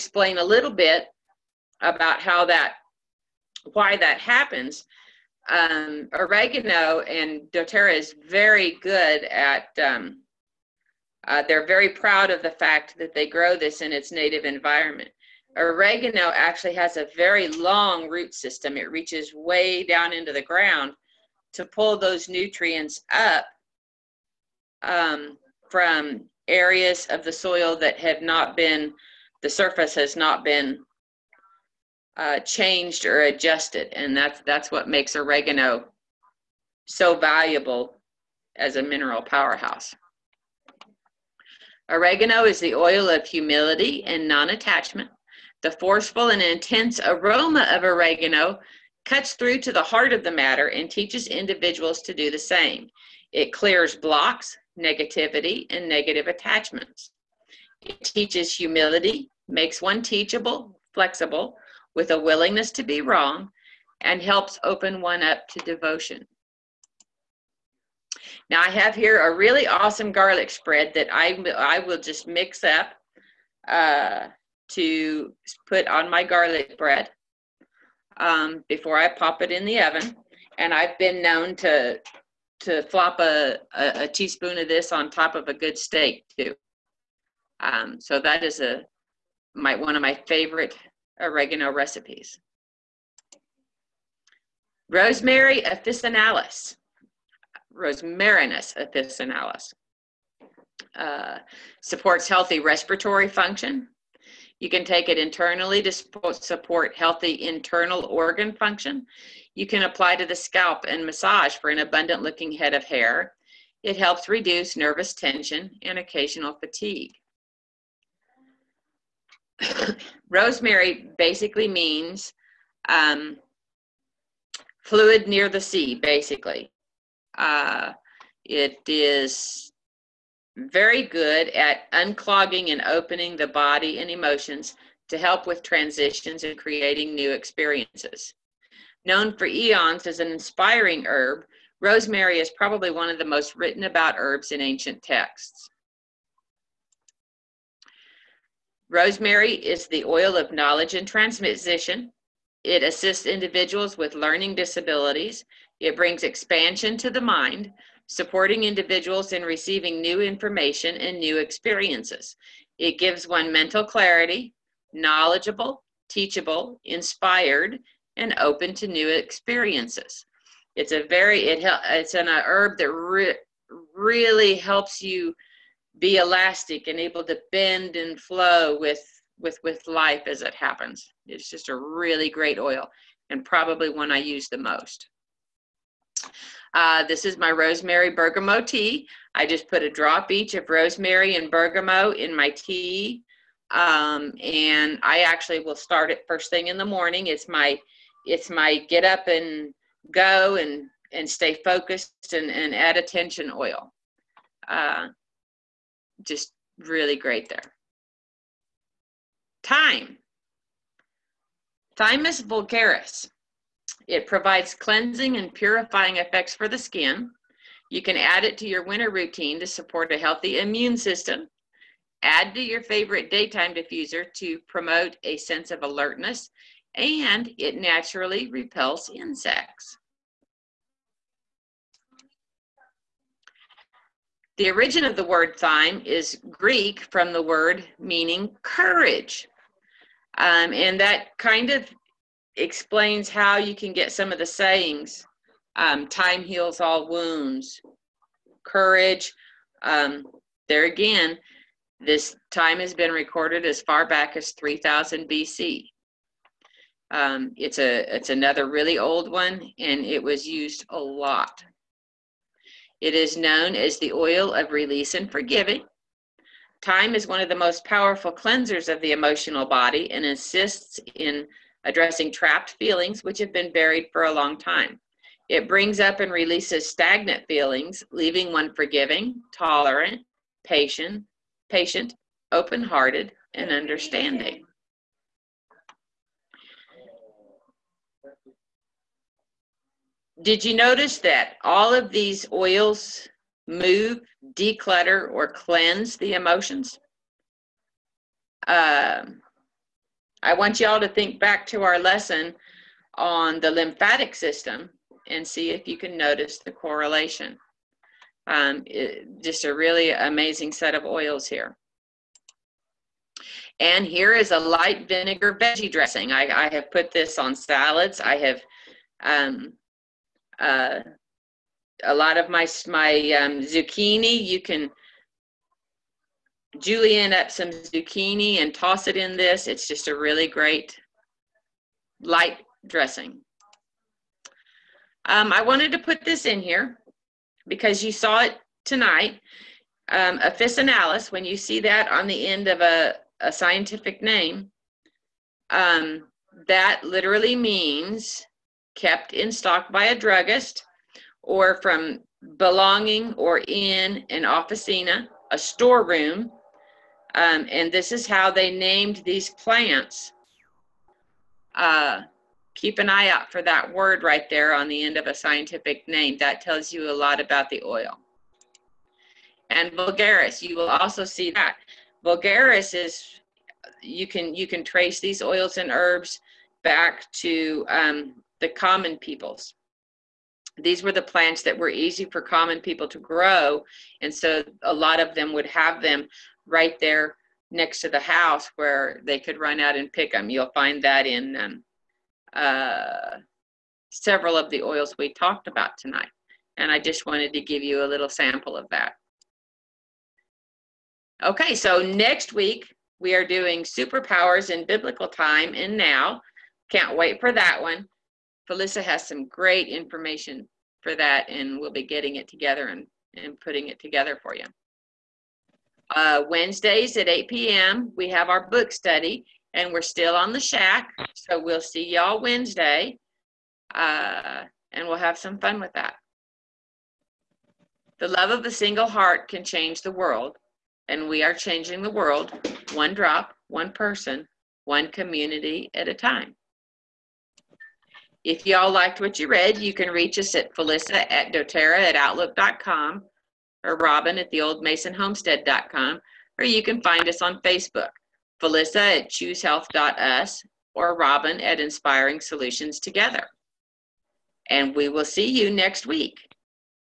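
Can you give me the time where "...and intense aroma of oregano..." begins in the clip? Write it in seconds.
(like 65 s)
46 s.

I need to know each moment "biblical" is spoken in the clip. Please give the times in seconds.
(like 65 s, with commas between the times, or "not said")
404 s.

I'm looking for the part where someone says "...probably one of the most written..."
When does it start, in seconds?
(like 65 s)
142 s.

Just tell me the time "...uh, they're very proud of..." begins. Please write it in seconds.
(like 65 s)
11 s.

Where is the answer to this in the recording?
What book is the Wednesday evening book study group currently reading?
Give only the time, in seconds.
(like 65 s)
420 s.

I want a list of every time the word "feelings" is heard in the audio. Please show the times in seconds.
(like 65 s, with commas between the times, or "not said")
272 s, 277 s.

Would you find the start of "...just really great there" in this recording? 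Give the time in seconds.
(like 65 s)
206 s.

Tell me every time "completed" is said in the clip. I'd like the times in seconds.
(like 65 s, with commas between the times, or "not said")
not said.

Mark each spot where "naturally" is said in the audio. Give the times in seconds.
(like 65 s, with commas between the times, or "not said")
227 s.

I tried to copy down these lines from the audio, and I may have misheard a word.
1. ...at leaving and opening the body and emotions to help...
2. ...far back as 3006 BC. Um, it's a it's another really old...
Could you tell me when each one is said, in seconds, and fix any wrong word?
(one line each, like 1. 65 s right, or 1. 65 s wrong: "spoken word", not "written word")
1. 131 s wrong: "unclogging", not "leaving"
2. 253 s wrong: "3000", not "3006".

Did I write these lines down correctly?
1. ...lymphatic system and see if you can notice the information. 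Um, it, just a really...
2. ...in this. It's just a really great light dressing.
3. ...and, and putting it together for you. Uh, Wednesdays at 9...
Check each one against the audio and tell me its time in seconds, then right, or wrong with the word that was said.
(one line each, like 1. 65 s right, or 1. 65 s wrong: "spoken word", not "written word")
1. 303 s wrong: "correlation", not "information"
2. 329 s right
3. 412 s wrong: "8", not "9".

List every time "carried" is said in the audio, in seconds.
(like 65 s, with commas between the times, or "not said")
not said.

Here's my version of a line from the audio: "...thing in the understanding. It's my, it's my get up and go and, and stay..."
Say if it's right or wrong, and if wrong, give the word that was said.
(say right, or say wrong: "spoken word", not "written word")
wrong: "morning", not "understanding".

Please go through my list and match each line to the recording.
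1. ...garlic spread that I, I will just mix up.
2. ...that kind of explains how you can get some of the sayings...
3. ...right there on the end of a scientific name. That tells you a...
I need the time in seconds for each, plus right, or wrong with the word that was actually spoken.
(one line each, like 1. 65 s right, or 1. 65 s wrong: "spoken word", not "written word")
1. 70 s right
2. 240 s right
3. 364 s right.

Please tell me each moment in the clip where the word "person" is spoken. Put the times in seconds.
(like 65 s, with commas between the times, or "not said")
433 s.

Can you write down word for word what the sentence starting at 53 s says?
It clears blocks, negativity, and negative attachments.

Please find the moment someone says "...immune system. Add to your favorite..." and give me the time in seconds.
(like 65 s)
220 s.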